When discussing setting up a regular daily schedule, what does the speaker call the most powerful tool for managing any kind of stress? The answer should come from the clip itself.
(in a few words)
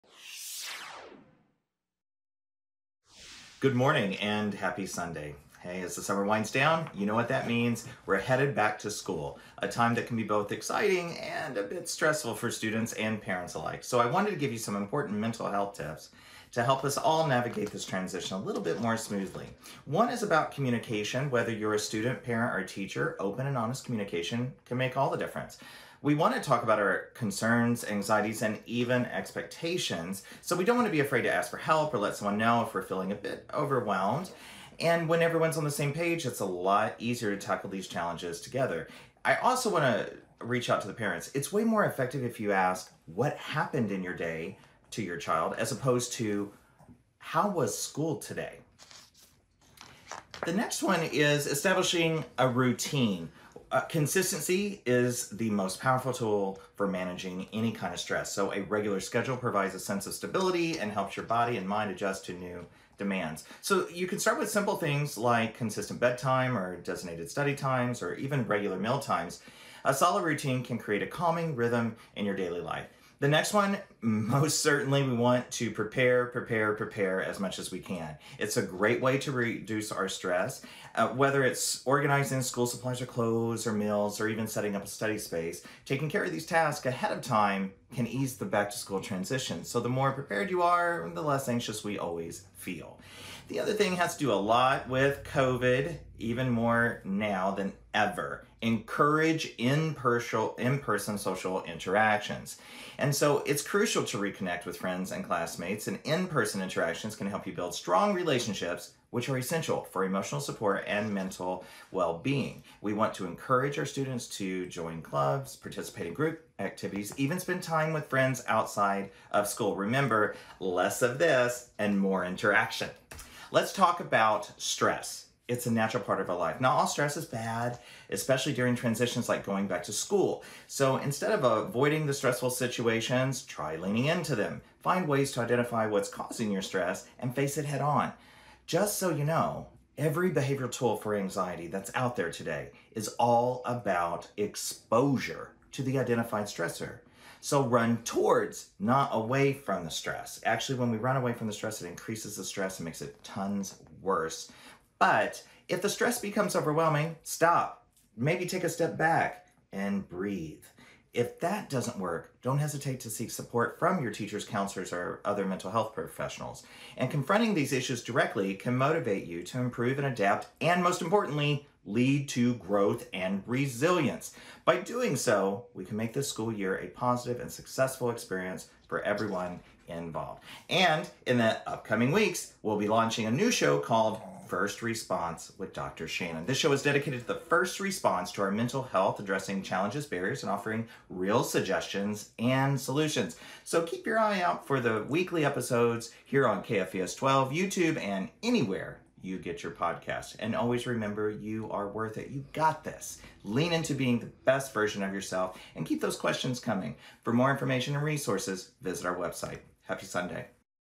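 Consistency.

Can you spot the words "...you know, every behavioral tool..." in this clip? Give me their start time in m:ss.
2:19.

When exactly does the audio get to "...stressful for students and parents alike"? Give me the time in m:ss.
0:11.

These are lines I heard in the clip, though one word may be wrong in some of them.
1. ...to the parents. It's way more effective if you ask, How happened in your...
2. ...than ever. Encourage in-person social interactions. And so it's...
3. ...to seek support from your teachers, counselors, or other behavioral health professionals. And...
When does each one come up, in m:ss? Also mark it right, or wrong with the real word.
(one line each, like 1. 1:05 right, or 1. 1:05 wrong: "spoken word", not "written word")
1. 0:40 wrong: "What", not "How"
2. 1:37 right
3. 2:43 wrong: "mental", not "behavioral".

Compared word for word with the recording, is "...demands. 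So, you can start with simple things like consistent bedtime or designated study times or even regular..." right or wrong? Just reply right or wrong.
right.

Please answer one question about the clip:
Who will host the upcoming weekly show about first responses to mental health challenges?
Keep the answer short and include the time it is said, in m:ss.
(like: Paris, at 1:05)
Dr. Shannon, at 3:05.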